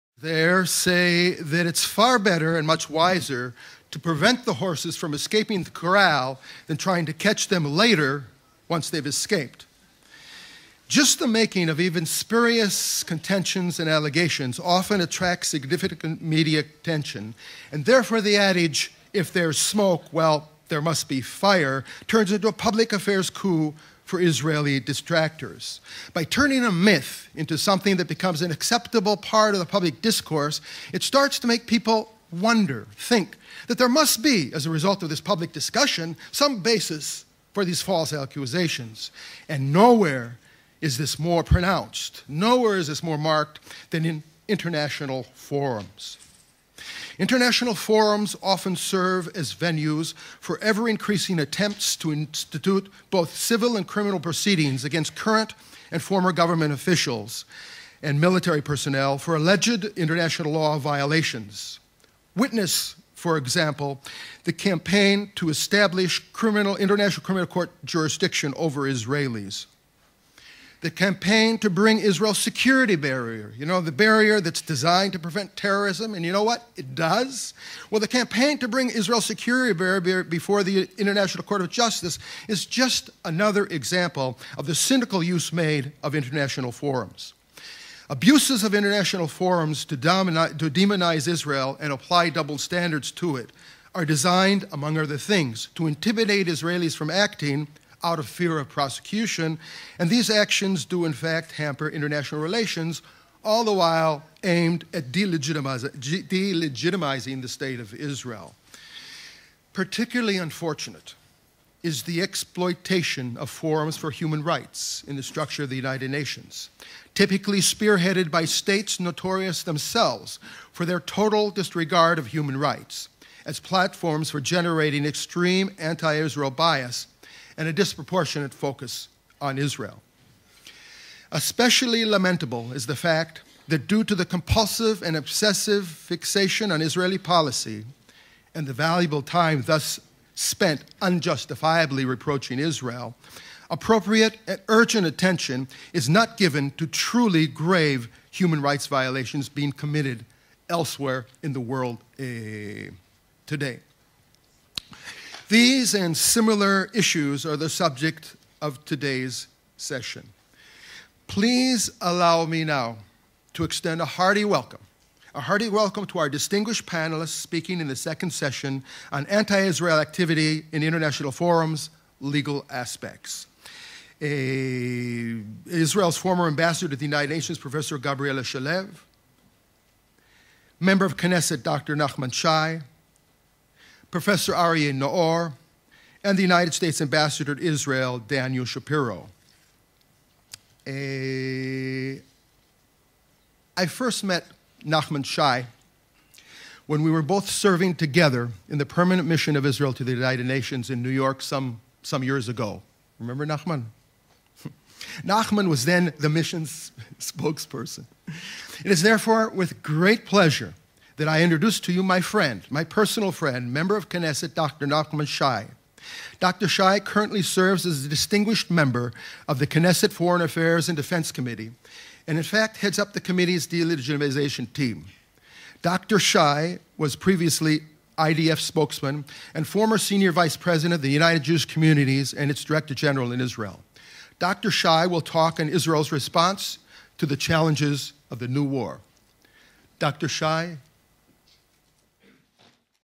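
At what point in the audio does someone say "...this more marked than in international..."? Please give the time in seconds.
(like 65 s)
42 s.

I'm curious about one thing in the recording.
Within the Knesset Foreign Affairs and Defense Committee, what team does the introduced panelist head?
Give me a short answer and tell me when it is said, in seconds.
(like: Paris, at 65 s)
delegitimization team, at 223 s.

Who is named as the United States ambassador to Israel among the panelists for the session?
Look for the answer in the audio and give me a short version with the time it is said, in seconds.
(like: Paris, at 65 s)
Daniel Shapiro, at 188 s.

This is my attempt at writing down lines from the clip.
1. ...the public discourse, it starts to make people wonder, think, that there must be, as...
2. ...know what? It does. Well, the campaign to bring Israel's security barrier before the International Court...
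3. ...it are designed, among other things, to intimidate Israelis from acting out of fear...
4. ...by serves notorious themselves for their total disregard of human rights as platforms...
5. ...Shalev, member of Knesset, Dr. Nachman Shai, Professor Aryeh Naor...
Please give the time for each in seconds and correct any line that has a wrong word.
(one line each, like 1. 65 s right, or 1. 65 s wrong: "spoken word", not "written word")
1. 29 s right
2. 76 s right
3. 93 s right
4. 118 s wrong: "states", not "serves"
5. 178 s right.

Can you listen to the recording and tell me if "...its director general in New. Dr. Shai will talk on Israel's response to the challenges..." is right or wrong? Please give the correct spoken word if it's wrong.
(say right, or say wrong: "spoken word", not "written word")
wrong: "Israel", not "New".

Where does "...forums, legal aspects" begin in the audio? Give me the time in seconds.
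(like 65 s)
171 s.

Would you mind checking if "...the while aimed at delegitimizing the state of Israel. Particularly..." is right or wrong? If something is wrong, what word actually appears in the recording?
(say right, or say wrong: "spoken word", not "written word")
right.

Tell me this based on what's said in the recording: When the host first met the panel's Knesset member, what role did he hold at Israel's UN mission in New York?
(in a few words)
spokesperson.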